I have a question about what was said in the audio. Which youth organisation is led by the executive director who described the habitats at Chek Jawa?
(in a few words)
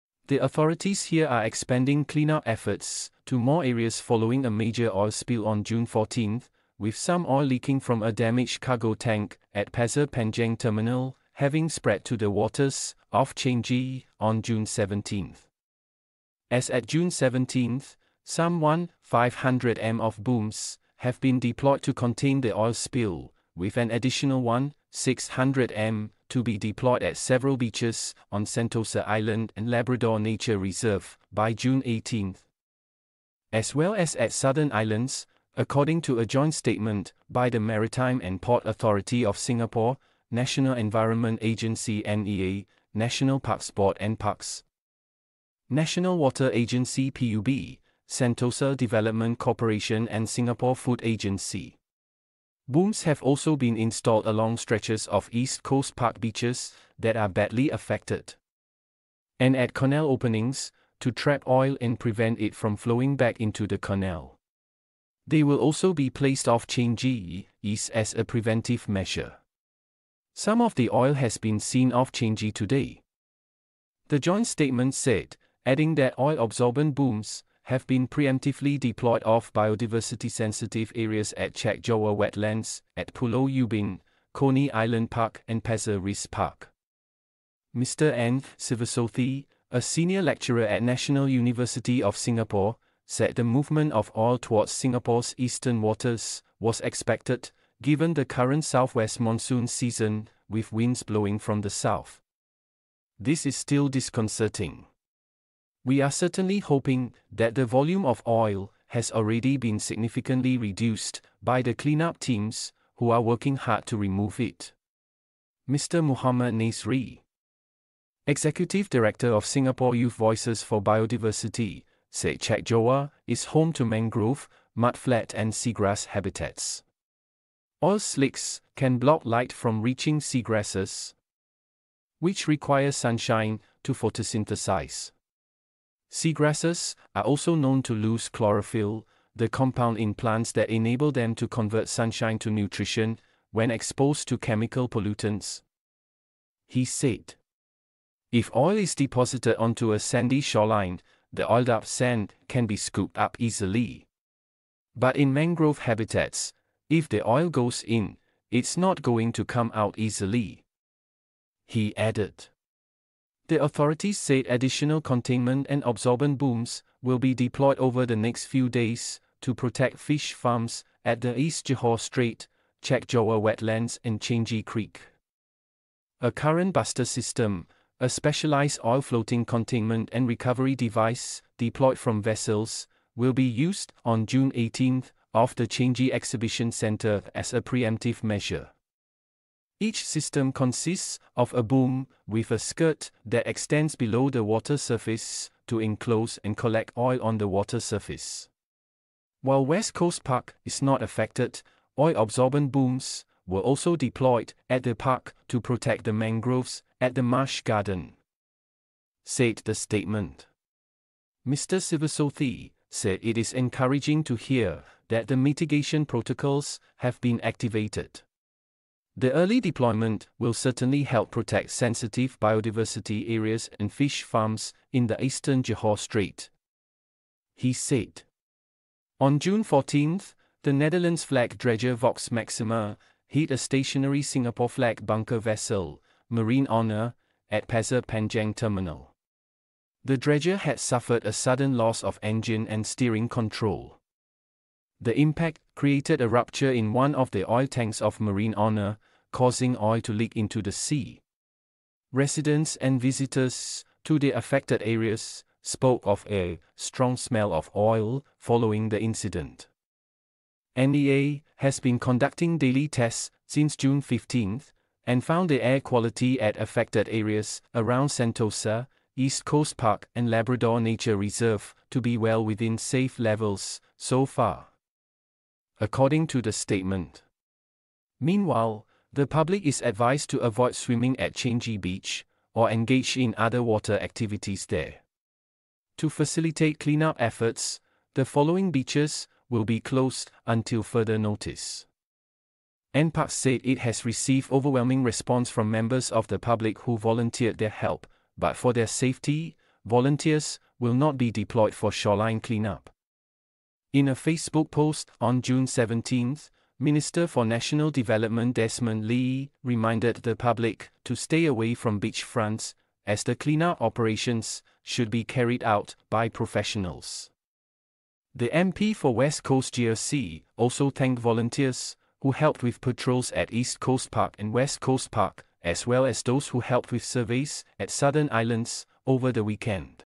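Singapore Youth Voices for Biodiversity.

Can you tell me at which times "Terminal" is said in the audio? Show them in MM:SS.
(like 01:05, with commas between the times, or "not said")
00:10, 03:58.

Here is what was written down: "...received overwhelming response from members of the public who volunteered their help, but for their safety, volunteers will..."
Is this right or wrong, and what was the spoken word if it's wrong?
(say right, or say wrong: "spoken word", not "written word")
right.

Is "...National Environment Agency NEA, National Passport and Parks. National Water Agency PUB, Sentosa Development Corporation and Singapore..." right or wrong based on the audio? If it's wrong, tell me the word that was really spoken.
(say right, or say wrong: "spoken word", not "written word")
right.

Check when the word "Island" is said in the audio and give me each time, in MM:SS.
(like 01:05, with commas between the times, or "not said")
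00:29, 00:34, 01:24, 05:28.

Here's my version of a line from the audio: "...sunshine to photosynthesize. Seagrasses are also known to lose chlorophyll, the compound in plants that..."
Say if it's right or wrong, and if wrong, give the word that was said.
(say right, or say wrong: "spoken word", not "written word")
right.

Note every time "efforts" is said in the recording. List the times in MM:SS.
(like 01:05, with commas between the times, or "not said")
00:02, 04:47.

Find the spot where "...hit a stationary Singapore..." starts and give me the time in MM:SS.
03:53.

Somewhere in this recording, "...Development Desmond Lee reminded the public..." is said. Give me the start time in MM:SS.
05:07.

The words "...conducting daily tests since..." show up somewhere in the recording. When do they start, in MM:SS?
04:21.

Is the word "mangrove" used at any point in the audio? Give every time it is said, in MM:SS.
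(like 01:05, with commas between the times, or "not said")
02:03, 02:35, 03:26.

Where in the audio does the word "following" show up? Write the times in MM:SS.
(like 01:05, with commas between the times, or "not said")
00:03, 04:18, 04:48.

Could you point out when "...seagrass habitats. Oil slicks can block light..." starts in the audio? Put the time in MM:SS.
02:05.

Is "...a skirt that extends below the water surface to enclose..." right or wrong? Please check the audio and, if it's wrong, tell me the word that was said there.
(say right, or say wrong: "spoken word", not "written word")
right.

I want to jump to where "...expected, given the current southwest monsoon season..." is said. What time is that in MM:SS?
01:36.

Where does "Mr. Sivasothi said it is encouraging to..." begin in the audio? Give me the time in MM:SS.
03:31.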